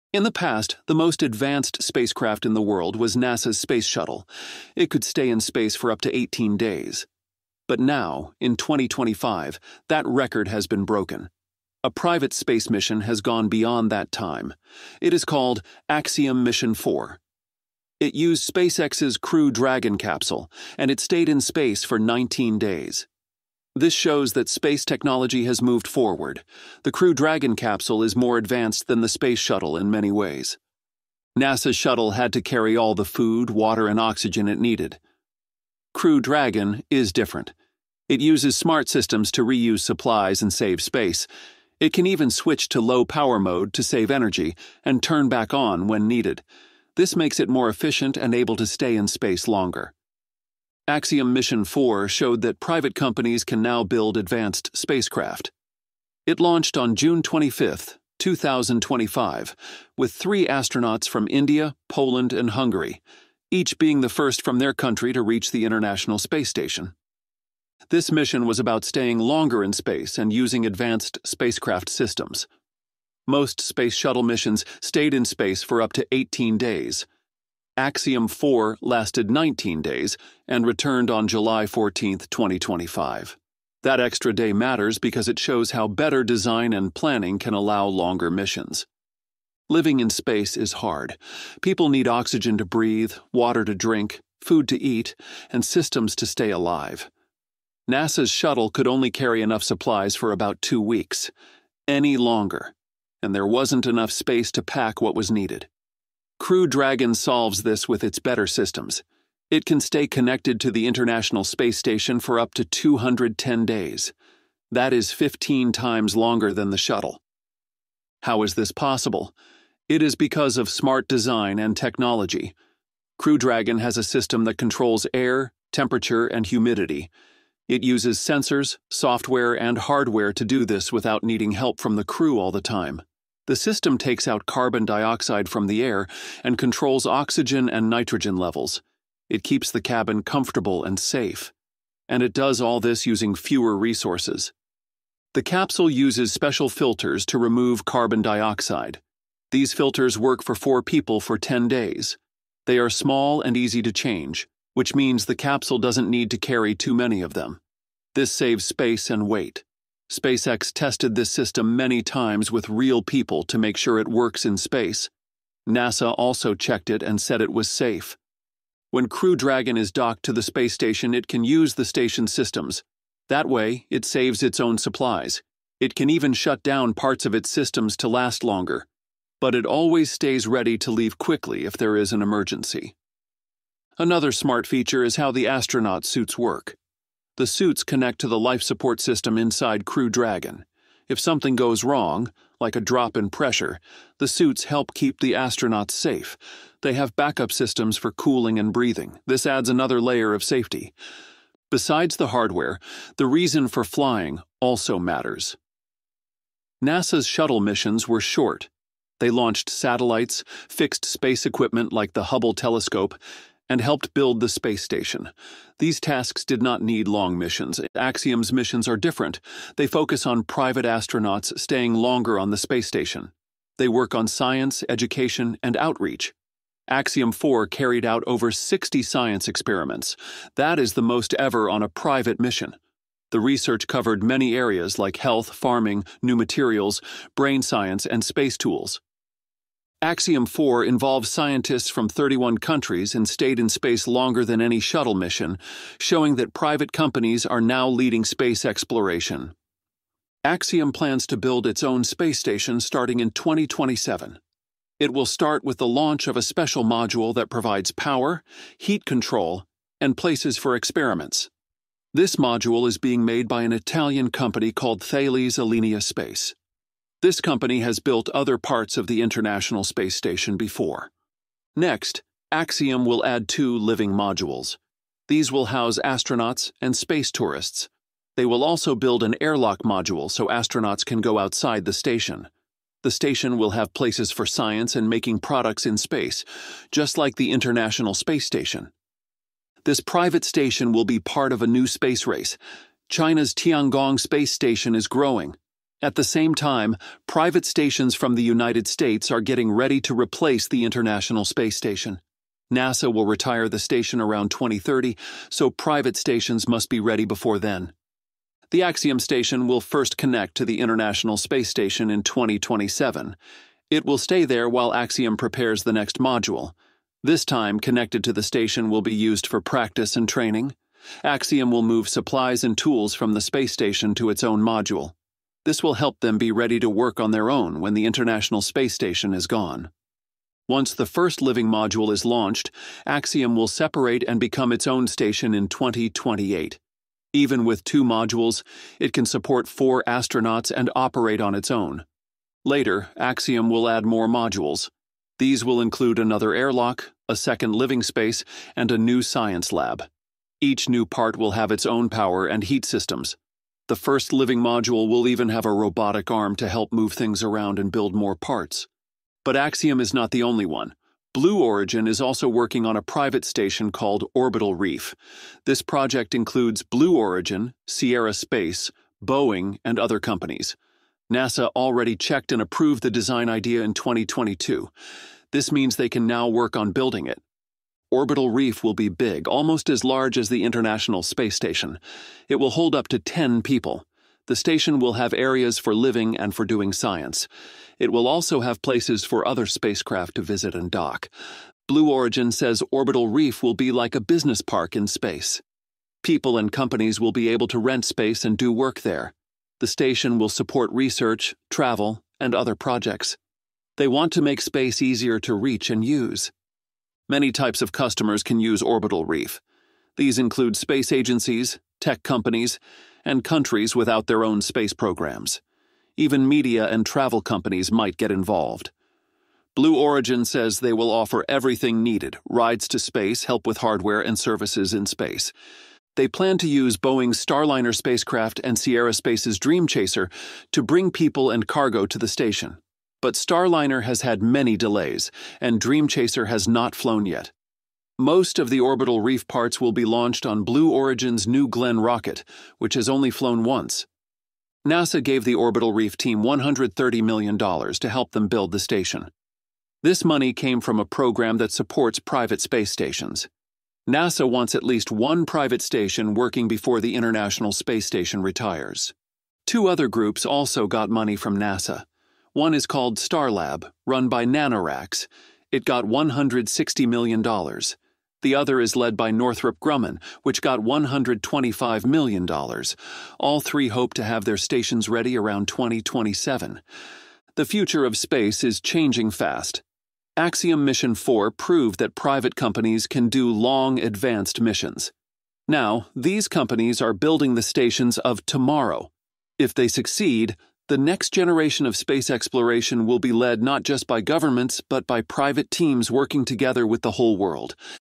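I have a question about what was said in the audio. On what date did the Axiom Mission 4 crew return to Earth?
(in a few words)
July 14, 2025.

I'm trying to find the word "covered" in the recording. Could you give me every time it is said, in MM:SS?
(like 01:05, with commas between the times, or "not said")
03:53.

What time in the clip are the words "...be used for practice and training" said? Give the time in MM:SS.
05:19.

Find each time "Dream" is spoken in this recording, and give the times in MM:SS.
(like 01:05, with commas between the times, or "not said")
07:09, 07:15.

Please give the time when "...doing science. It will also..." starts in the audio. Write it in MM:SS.
06:26.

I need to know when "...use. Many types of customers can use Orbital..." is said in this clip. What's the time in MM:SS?
06:46.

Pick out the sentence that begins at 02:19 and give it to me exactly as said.
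It keeps the cabin comfortable and safe.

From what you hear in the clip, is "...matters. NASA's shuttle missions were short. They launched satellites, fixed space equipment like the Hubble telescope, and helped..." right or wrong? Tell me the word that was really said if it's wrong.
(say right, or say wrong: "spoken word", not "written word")
right.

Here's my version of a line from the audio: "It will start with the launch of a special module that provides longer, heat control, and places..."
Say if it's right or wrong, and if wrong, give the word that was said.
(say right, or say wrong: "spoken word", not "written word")
wrong: "power", not "longer".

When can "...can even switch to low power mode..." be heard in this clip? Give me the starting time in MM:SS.
00:41.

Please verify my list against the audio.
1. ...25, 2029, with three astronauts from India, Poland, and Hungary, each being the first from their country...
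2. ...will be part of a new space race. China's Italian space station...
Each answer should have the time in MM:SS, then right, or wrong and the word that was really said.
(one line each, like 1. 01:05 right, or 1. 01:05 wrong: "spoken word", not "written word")
1. 00:57 wrong: "2025", not "2029"
2. 04:50 wrong: "Tiangong", not "Italian".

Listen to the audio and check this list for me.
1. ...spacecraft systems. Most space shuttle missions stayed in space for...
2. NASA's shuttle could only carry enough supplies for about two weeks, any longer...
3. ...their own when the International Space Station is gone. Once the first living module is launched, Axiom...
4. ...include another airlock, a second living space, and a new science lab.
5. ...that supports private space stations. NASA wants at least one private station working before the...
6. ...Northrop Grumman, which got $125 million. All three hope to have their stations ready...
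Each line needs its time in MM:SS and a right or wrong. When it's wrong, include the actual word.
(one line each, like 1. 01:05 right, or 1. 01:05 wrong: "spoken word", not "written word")
1. 01:11 right
2. 01:37 right
3. 05:27 right
4. 05:45 right
5. 07:31 right
6. 07:49 right.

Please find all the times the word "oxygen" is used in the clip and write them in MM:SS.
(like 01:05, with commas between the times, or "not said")
00:33, 01:32, 02:17.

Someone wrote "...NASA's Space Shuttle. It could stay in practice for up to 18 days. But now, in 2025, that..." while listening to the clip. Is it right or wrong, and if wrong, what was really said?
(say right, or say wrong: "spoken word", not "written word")
wrong: "space", not "practice".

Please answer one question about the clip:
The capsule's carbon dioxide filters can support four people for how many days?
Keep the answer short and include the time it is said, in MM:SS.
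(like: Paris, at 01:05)
10 days, at 02:31.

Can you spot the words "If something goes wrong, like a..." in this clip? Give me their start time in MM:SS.
03:11.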